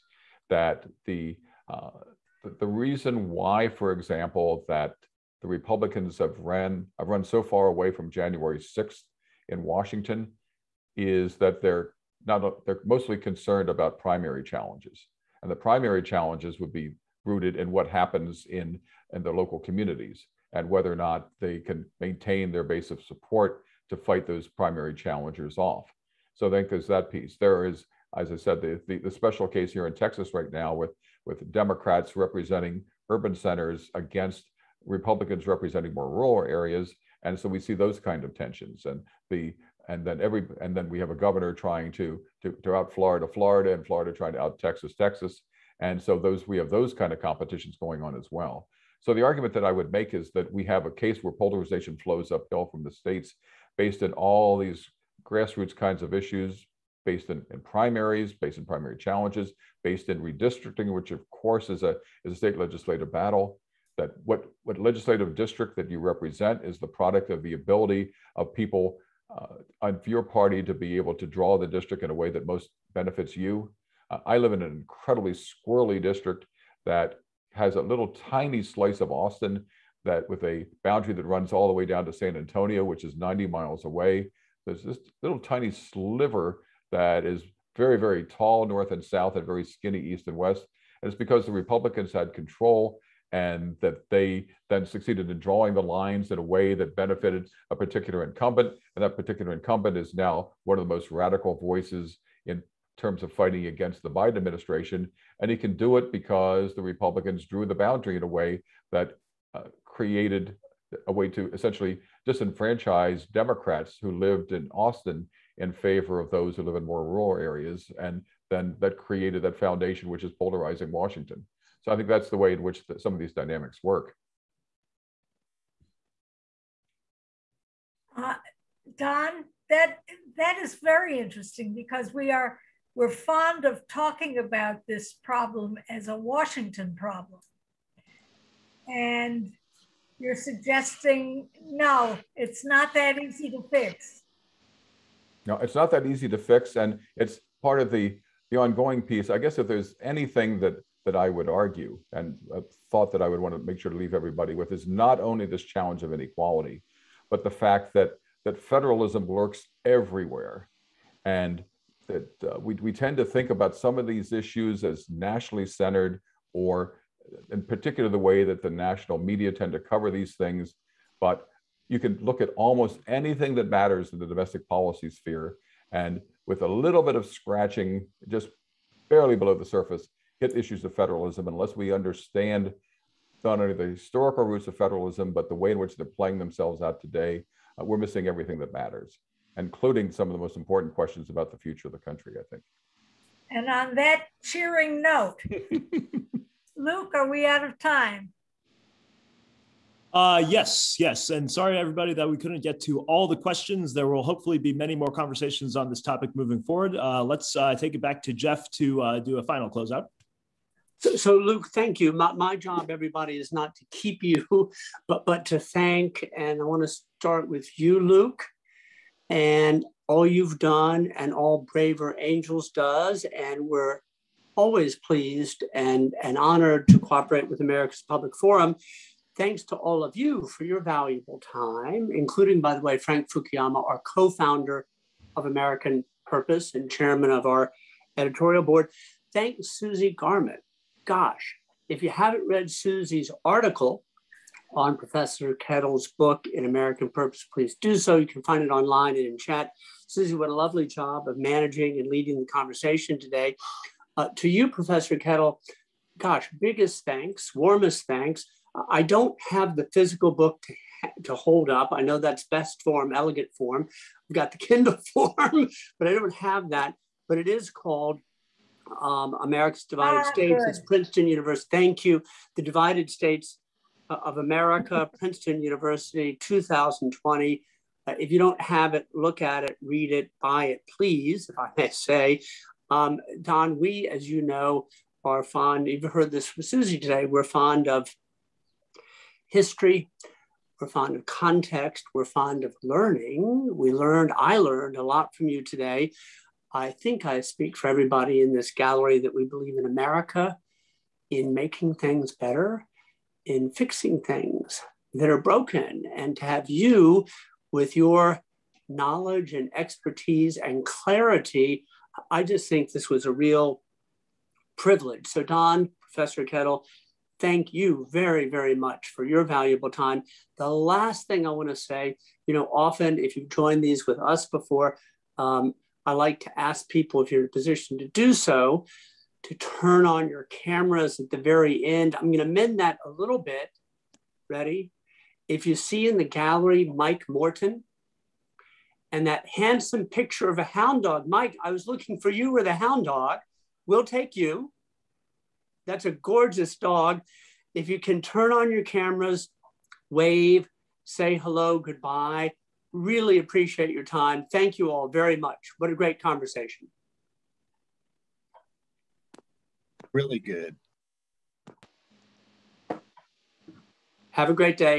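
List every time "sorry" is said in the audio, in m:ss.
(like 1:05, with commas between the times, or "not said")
3:21.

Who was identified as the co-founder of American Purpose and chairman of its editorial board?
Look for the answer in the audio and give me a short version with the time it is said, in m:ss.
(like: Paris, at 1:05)
Frank Fukuyama, at 3:52.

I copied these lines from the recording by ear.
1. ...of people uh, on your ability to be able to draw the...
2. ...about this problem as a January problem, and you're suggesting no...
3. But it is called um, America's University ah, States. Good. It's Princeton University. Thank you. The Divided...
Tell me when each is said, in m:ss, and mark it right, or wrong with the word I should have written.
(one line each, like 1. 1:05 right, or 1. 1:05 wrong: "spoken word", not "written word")
1. 1:08 wrong: "party", not "ability"
2. 2:14 wrong: "Washington", not "January"
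3. 4:27 wrong: "Divided", not "University".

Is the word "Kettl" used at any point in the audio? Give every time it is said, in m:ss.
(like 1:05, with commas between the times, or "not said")
4:05, 4:15, 5:16.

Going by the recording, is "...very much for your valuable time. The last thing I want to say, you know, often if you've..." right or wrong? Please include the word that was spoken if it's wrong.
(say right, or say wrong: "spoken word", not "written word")
right.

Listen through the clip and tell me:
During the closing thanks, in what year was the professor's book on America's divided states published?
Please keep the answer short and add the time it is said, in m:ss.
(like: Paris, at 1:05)
2020, at 4:36.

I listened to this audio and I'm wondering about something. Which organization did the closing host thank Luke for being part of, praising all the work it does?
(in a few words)
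Braver Angels.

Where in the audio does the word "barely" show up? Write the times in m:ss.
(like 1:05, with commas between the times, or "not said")
2:59.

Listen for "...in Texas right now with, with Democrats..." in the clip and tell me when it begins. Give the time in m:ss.
0:29.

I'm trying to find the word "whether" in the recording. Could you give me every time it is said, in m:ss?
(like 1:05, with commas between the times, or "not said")
0:20.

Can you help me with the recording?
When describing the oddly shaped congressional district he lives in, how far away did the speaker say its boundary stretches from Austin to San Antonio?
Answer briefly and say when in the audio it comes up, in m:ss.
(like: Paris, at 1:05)
90 miles, at 1:23.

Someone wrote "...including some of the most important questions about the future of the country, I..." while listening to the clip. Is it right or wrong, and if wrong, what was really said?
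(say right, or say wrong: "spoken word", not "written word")
right.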